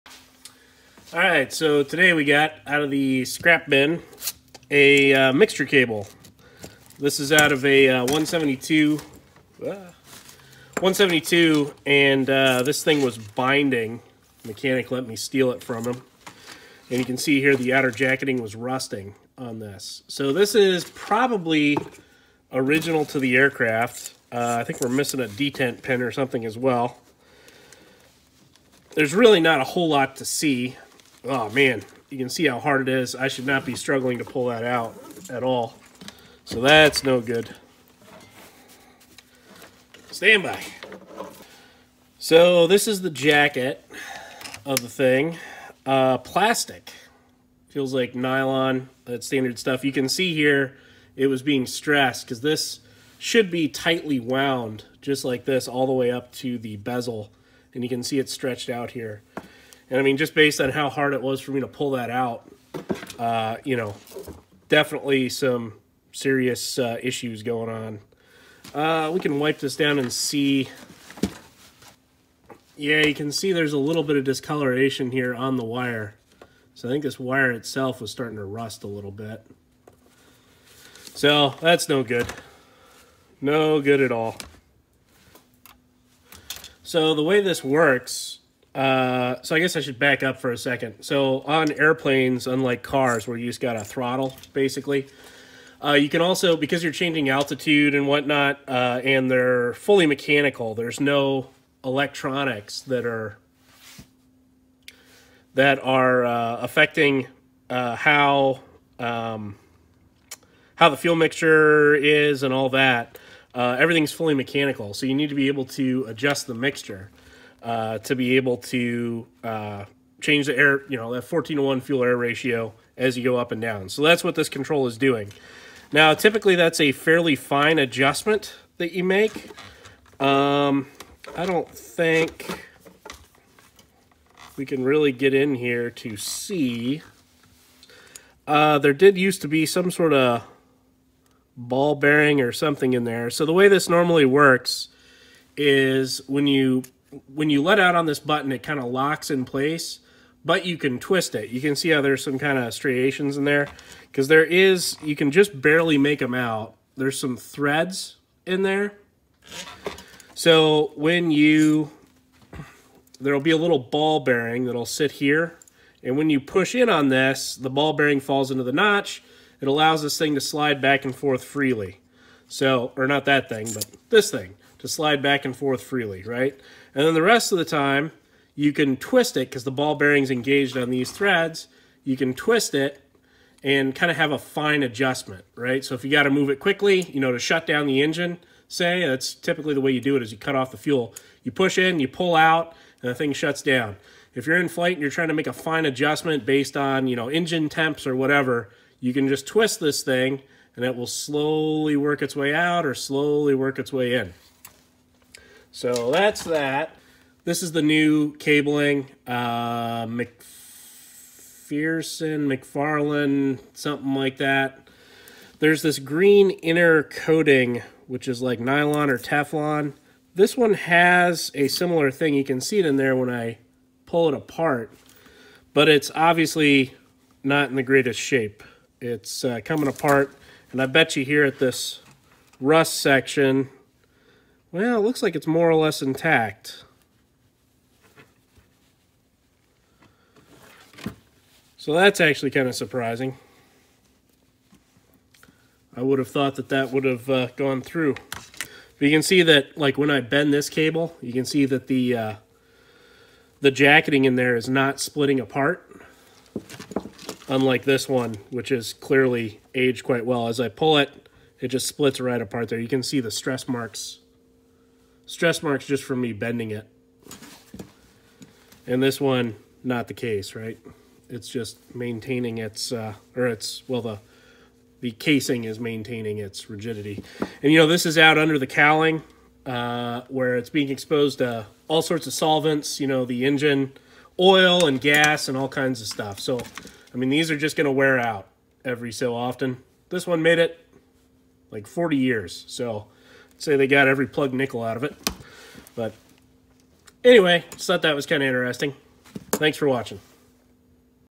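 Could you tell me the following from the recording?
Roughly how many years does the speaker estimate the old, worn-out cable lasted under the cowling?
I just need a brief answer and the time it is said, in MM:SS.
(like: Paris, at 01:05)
40 years, at 04:51.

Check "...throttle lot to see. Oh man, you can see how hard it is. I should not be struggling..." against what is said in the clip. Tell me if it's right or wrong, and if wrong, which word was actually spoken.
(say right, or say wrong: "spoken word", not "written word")
wrong: "whole", not "throttle".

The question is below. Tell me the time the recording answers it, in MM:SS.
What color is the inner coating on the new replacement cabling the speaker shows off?
03:35.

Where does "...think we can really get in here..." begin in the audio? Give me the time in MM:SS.
02:11.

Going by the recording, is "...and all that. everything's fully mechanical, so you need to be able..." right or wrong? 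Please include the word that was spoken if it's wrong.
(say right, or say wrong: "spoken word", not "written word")
right.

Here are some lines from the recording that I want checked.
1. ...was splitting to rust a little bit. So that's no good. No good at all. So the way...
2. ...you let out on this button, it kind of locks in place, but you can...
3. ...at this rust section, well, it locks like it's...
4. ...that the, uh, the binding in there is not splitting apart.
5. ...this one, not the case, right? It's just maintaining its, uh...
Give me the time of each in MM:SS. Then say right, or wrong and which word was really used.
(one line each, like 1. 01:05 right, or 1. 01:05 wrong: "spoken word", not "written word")
1. 01:17 wrong: "starting", not "splitting"
2. 02:27 right
3. 03:51 wrong: "looks", not "locks"
4. 04:11 wrong: "jacketing", not "binding"
5. 04:29 right.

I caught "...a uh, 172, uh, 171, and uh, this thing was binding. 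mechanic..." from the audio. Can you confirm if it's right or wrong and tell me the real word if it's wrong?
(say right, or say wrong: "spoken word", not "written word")
wrong: "172", not "171".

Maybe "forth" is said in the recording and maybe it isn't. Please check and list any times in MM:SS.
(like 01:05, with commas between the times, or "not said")
02:51, 02:55.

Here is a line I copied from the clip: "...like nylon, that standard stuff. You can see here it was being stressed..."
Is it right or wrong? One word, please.
right.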